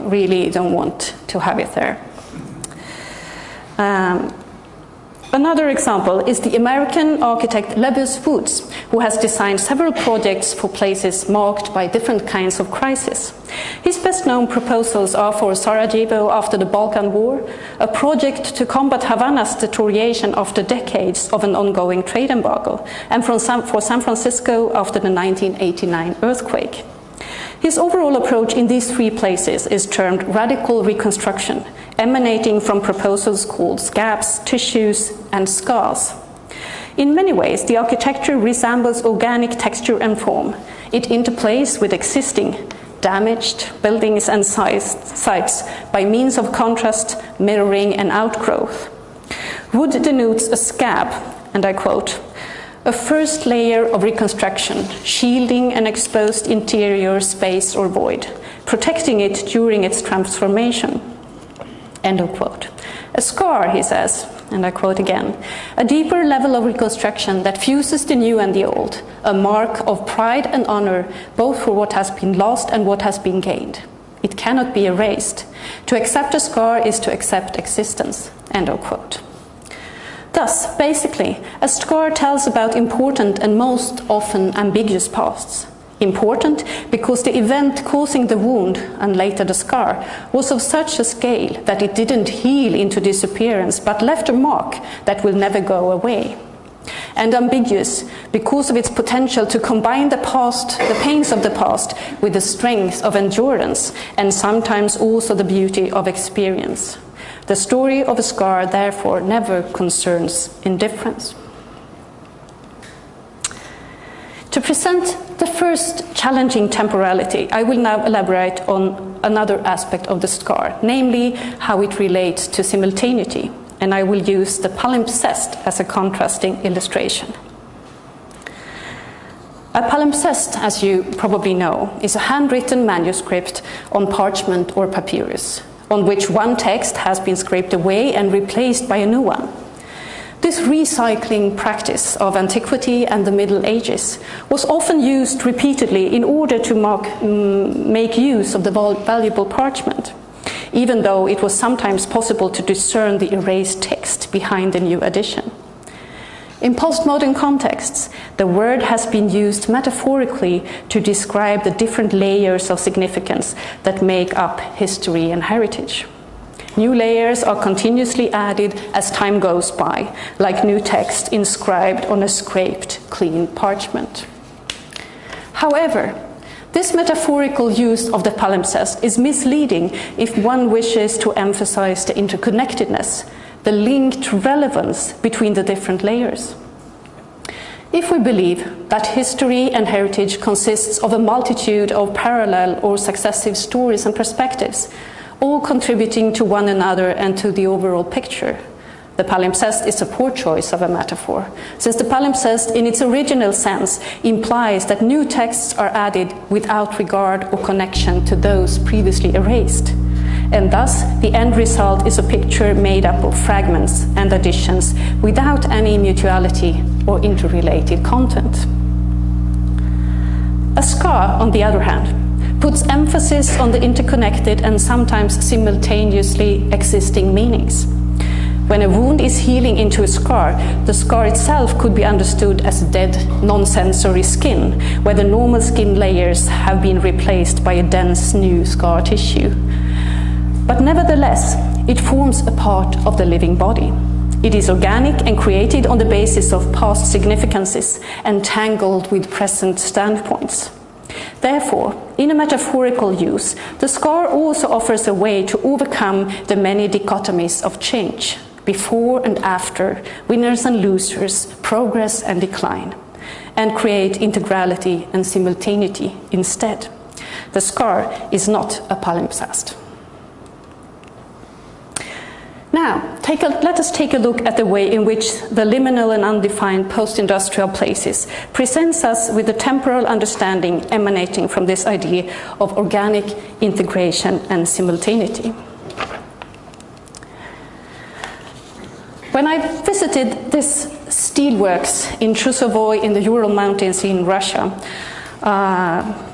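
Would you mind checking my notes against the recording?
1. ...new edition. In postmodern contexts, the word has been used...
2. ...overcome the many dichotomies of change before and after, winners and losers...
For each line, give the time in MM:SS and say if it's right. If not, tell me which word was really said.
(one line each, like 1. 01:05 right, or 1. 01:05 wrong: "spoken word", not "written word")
1. 02:34 right
2. 04:15 right.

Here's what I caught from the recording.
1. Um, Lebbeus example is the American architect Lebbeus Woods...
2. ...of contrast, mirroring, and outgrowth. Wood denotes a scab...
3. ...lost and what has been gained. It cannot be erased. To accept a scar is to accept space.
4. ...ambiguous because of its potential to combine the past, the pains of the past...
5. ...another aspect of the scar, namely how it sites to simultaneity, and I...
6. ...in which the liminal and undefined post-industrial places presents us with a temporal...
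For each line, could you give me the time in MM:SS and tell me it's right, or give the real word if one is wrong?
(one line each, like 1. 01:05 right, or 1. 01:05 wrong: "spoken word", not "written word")
1. 00:03 wrong: "Another", not "Lebbeus"
2. 00:46 right
3. 01:12 wrong: "existence", not "space"
4. 01:37 right
5. 01:59 wrong: "relates", not "sites"
6. 04:34 right.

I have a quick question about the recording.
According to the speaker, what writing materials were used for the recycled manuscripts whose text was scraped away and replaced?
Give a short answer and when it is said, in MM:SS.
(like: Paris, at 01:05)
parchment or papyrus, at 02:14.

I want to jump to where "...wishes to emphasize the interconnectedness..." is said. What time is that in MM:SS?
03:00.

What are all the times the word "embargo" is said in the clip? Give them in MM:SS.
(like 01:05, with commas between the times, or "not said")
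00:22.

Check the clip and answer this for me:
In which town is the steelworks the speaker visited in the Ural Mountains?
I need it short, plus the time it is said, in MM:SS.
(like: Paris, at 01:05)
Chusovoy, at 04:52.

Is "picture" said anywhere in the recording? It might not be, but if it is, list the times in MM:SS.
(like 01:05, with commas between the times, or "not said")
03:18, 03:32.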